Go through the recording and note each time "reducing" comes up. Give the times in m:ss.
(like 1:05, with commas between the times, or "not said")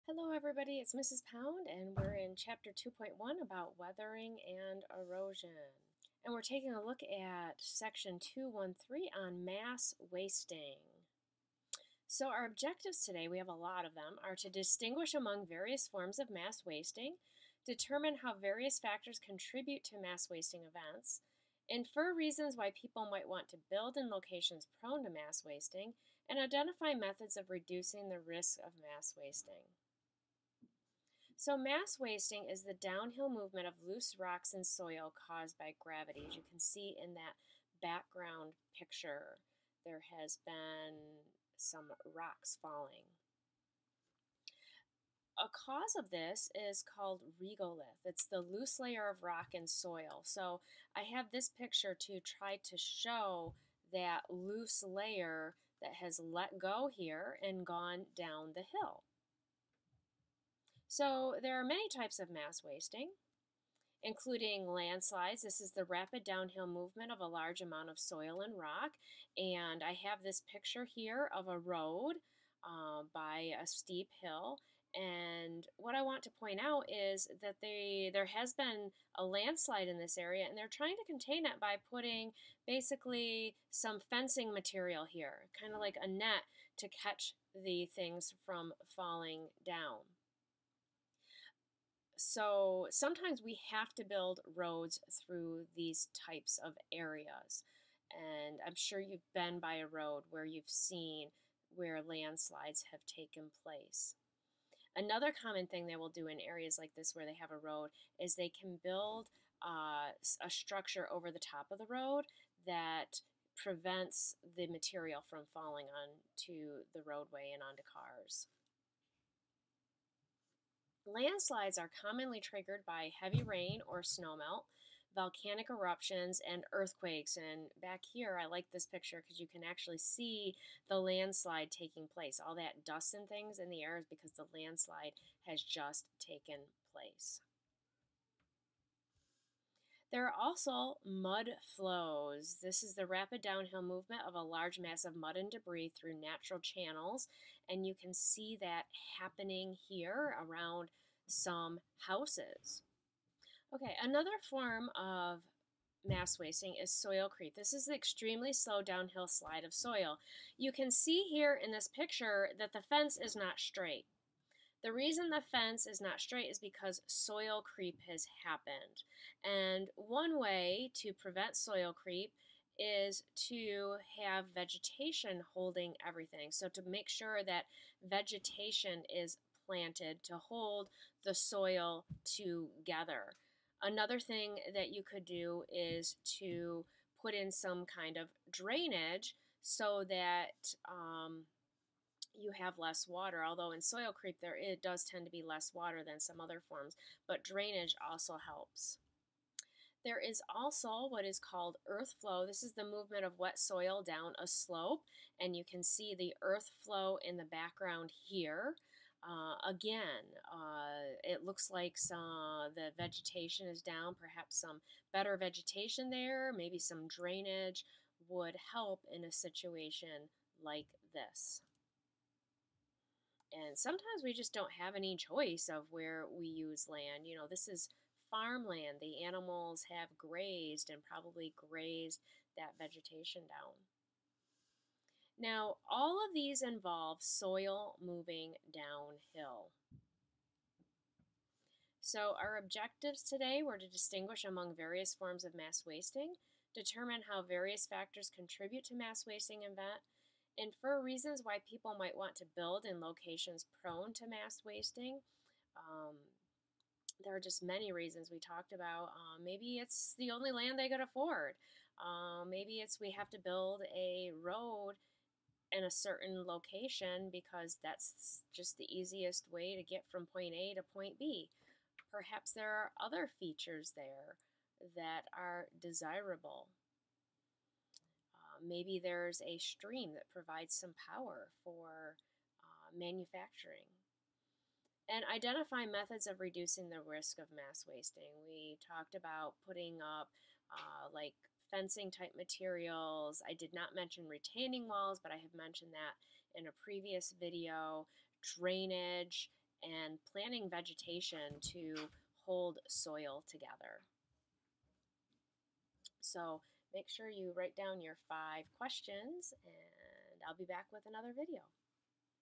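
0:27, 4:46.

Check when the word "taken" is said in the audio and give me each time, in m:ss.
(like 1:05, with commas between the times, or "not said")
1:43, 2:16.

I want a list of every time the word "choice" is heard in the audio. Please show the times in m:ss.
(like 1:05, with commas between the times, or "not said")
3:45.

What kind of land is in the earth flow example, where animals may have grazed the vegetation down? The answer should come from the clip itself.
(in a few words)
Farmland.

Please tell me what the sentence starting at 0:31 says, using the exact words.
So, mass wasting is the downhill movement of loose rocks and soil caused by gravity.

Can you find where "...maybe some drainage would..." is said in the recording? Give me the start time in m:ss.
3:36.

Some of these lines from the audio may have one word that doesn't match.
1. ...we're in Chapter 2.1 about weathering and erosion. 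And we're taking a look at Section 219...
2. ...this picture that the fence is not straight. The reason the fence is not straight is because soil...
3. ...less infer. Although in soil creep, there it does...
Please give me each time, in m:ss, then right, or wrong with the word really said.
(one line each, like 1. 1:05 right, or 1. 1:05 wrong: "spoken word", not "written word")
1. 0:01 wrong: "213", not "219"
2. 2:41 right
3. 3:12 wrong: "water", not "infer".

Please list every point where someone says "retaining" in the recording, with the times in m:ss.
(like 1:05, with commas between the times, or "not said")
4:54.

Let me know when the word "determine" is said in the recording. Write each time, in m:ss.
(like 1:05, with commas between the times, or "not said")
0:17, 4:06.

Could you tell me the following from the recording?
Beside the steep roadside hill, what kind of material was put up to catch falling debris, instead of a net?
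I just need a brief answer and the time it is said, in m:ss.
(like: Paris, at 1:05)
Fencing material, at 1:24.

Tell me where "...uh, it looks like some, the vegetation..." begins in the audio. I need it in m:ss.
3:30.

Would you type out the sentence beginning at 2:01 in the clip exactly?
Landslides are commonly triggered by heavy rain or snowmelt, volcanic eruptions, and earthquakes.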